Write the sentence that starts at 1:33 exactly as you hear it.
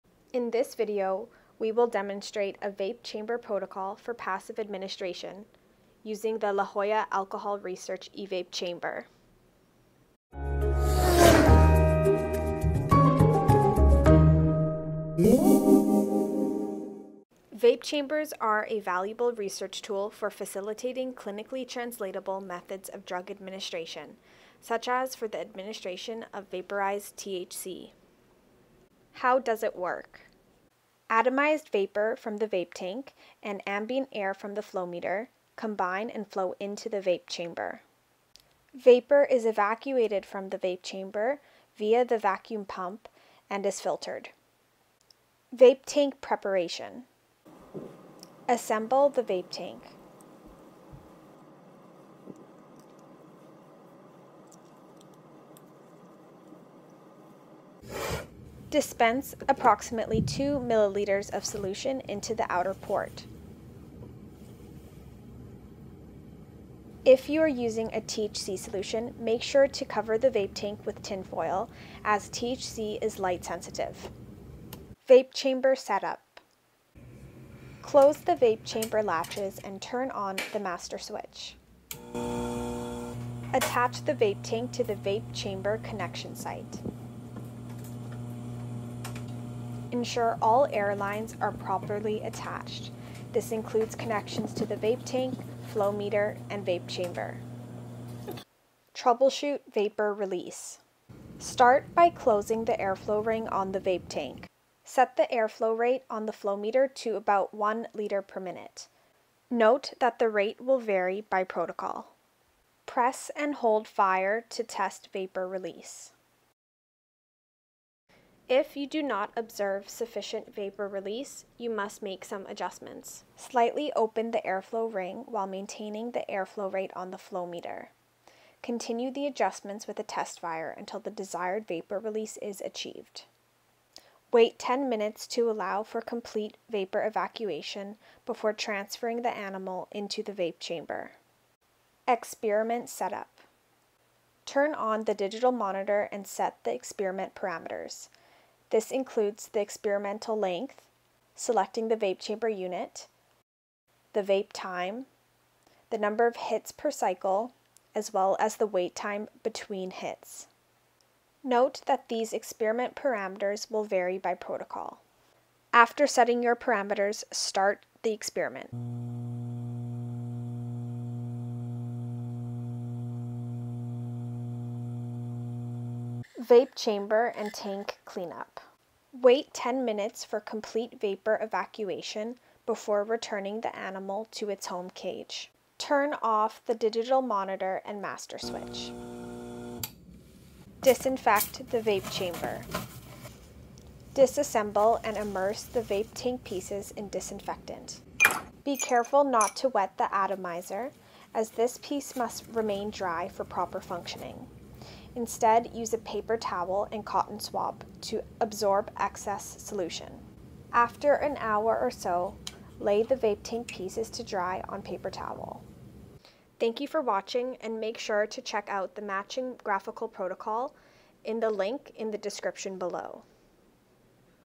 This includes connections to the vape tank, flow meter, and vape chamber.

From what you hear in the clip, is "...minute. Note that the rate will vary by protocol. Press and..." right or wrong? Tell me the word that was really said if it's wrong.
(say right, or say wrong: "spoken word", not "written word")
right.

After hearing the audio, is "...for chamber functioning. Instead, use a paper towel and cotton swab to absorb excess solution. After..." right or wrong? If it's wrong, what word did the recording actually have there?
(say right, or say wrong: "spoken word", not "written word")
wrong: "proper", not "chamber".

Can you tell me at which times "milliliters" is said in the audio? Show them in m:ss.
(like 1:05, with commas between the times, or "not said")
1:00.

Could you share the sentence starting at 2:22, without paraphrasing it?
Experiment Setup Turn on the digital monitor and set the experiment parameters.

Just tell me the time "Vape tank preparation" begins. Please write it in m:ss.
0:45.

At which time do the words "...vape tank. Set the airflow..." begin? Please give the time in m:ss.
1:43.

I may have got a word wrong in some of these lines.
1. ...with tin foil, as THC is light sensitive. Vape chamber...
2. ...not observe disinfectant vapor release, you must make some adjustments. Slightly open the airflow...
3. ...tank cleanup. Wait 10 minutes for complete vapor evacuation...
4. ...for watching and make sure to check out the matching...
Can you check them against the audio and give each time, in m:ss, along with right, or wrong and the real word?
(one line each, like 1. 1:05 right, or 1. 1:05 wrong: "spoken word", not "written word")
1. 1:10 right
2. 1:59 wrong: "sufficient", not "disinfectant"
3. 2:57 right
4. 3:36 right.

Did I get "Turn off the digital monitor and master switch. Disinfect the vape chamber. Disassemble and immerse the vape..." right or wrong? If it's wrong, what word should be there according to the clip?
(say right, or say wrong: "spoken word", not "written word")
right.